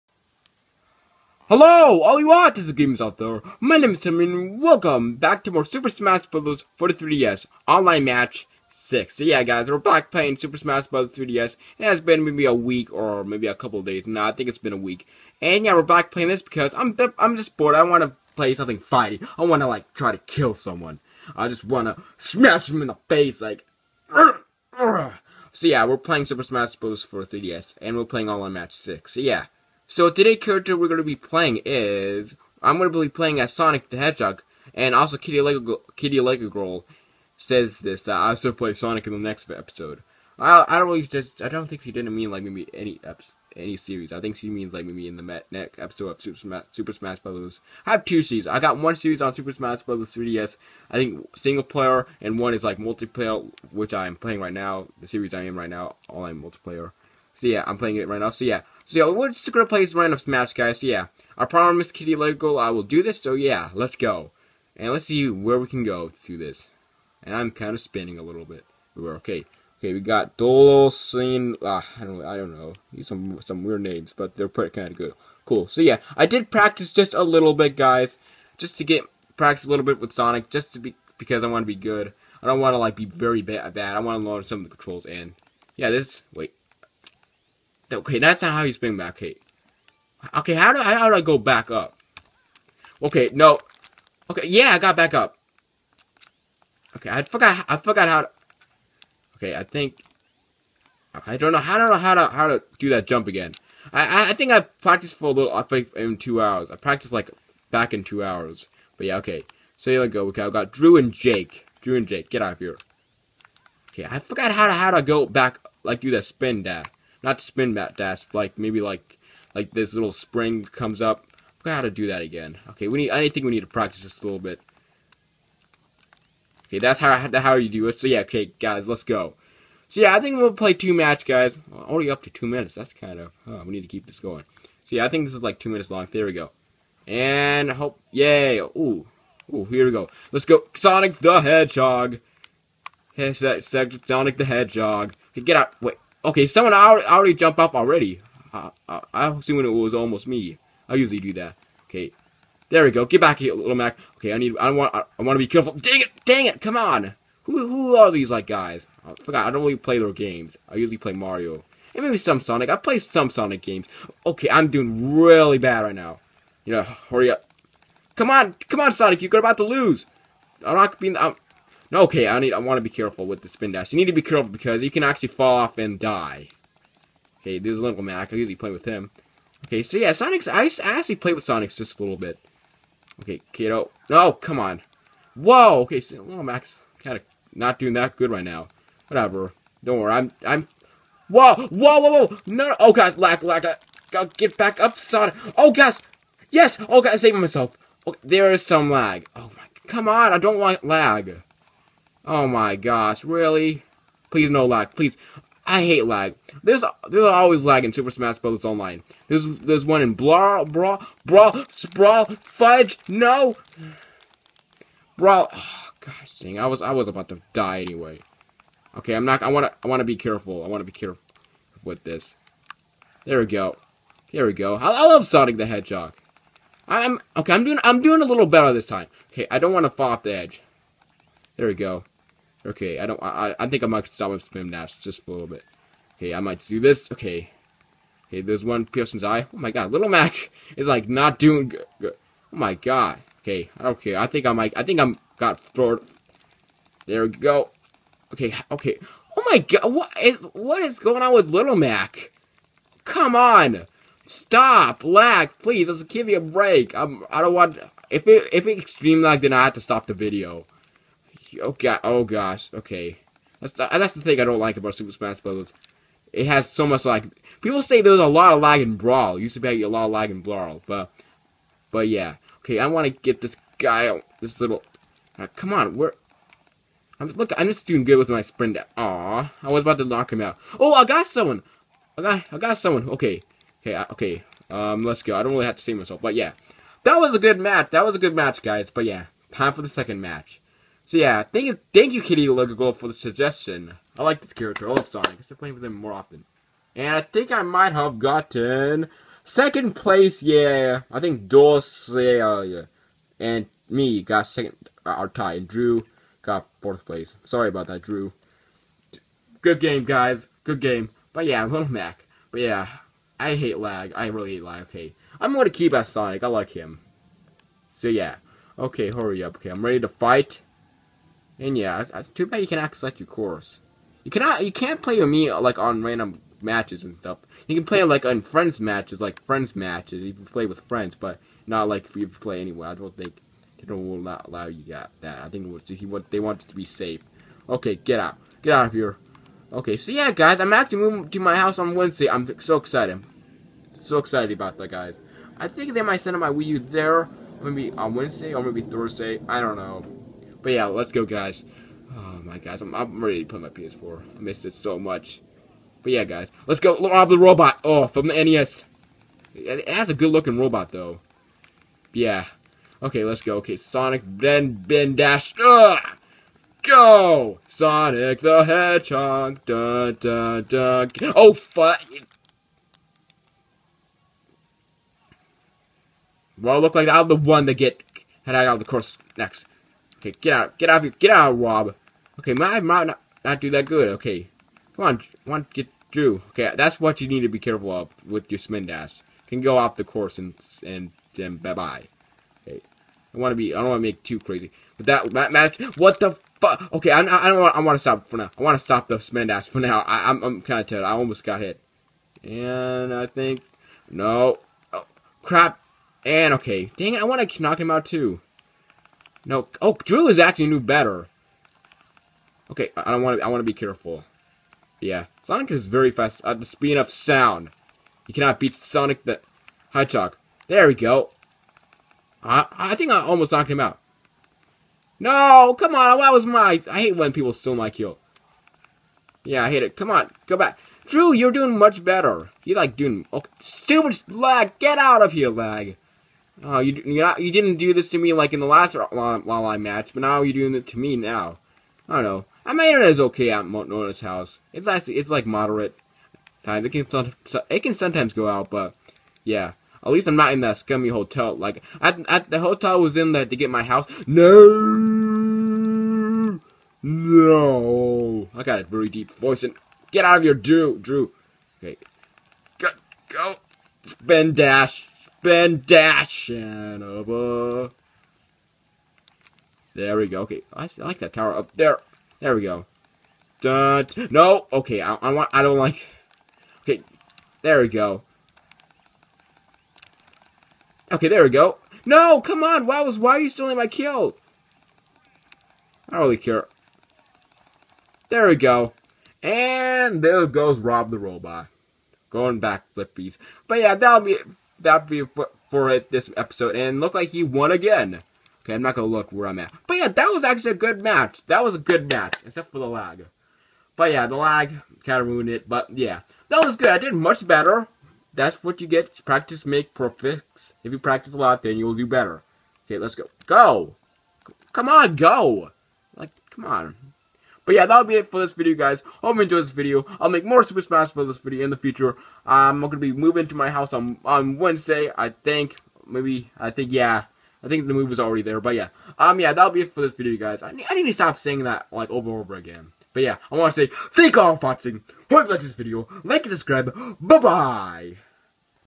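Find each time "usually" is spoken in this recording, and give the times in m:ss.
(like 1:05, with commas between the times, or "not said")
2:30, 2:40, 2:58.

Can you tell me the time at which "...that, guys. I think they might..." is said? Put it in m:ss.
5:44.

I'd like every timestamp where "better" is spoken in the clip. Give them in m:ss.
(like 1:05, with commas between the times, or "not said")
3:48, 6:50, 7:12, 8:27, 8:32.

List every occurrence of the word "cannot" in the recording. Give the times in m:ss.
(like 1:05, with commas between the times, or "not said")
5:24, 6:58.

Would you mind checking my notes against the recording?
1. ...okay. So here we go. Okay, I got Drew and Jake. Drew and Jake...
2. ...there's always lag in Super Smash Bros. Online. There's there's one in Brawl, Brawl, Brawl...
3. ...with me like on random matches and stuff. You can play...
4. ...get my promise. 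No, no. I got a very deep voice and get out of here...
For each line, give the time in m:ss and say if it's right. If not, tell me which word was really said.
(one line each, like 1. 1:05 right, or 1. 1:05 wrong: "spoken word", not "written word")
1. 1:49 right
2. 3:27 right
3. 5:25 right
4. 7:33 wrong: "house", not "promise".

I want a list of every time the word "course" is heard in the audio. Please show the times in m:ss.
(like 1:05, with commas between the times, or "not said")
5:23, 6:18, 6:30.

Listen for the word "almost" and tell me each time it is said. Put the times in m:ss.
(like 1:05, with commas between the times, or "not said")
2:29, 6:41, 7:03.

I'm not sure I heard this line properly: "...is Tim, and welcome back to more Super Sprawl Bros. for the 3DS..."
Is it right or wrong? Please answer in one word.
wrong.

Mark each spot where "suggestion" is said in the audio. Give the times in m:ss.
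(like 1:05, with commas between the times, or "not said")
4:53.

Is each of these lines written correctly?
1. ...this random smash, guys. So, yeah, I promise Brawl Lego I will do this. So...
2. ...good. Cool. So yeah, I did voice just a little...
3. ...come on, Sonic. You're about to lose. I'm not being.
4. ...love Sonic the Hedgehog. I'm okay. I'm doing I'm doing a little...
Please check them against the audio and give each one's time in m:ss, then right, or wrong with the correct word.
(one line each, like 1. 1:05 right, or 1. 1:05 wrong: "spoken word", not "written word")
1. 0:59 wrong: "Kitty", not "Brawl"
2. 1:14 wrong: "practice", not "voice"
3. 2:48 right
4. 3:45 right.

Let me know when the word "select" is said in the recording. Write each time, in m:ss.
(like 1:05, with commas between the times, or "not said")
5:22.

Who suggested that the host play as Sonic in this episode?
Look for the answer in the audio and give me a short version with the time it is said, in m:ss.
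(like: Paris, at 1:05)
Kitty Lego Girl, at 0:35.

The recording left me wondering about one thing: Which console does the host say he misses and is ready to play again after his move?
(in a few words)
PS4.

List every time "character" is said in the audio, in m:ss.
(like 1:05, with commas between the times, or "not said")
0:30, 4:54.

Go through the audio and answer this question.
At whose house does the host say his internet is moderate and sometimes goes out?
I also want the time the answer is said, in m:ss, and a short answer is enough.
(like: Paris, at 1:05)
Mona's, at 7:23.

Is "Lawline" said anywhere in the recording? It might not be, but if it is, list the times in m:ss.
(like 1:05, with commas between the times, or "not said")
7:18.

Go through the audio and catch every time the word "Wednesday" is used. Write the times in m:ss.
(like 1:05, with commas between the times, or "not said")
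5:41, 5:48, 8:44.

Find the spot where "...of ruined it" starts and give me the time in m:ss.
8:25.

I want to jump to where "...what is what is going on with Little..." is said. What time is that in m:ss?
4:09.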